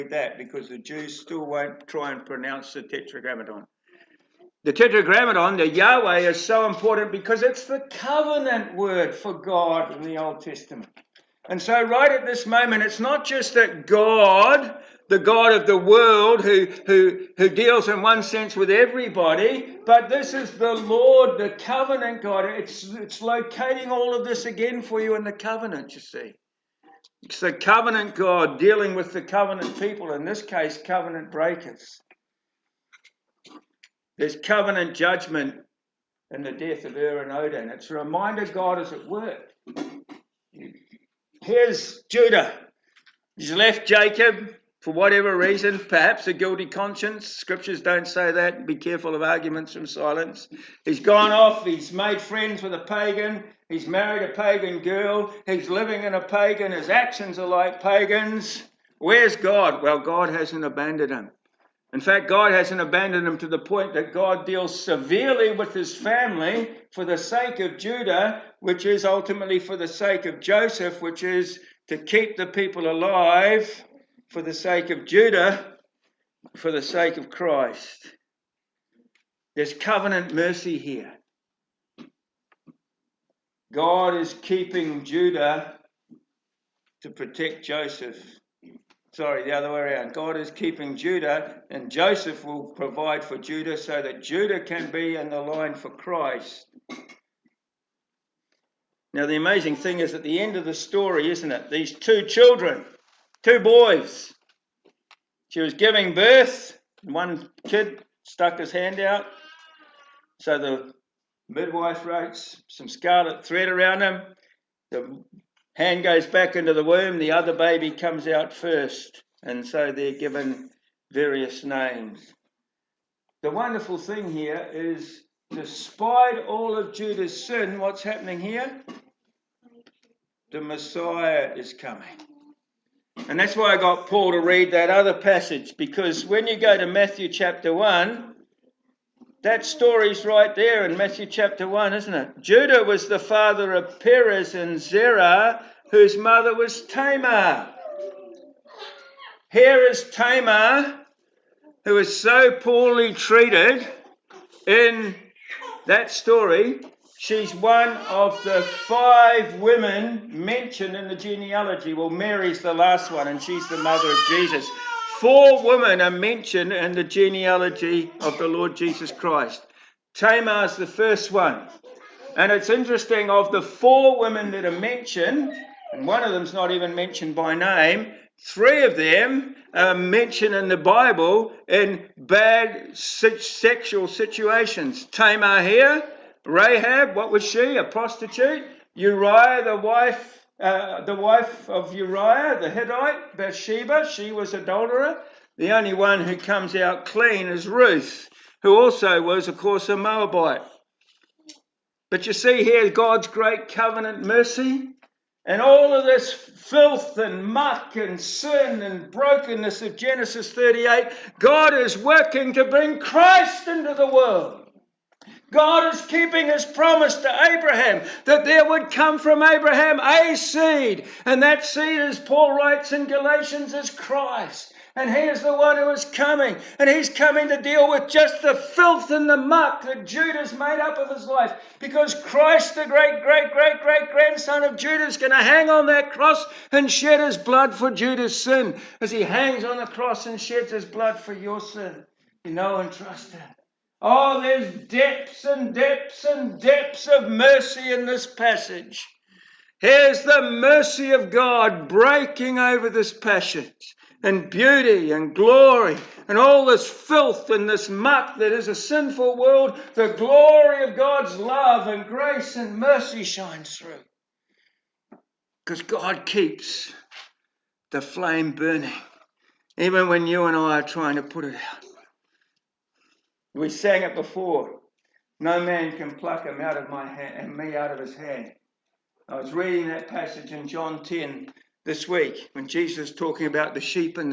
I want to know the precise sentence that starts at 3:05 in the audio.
Tamar here, Rahab, what was she?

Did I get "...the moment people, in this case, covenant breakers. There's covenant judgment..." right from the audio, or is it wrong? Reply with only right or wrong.
wrong.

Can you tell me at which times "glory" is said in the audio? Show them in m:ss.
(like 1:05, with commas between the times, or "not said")
4:15, 4:20.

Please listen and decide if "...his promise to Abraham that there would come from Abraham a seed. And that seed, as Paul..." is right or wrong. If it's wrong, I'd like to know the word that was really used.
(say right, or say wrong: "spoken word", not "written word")
right.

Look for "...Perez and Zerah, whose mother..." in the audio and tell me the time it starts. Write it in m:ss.
2:24.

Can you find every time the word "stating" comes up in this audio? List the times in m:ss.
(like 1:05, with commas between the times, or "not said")
not said.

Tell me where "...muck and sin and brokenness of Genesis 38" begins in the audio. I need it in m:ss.
3:27.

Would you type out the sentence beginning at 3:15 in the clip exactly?
The only one who comes out clean is Ruth, who also was, of course, a Moabite.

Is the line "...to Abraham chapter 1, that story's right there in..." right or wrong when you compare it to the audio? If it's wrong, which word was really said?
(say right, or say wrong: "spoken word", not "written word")
wrong: "Matthew", not "Abraham".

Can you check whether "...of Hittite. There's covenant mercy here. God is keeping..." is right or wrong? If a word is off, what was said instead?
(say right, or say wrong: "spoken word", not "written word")
wrong: "Christ", not "Hittite".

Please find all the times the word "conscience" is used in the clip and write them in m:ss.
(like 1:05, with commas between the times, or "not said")
0:46.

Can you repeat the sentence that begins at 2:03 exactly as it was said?
The wonderful thing here is, despite all of Judah's sin, what's happening here?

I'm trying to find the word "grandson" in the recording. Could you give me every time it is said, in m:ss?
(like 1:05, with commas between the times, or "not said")
3:54.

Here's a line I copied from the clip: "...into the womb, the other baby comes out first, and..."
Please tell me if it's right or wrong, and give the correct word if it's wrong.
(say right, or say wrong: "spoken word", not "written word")
right.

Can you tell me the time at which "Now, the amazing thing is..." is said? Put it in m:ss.
1:39.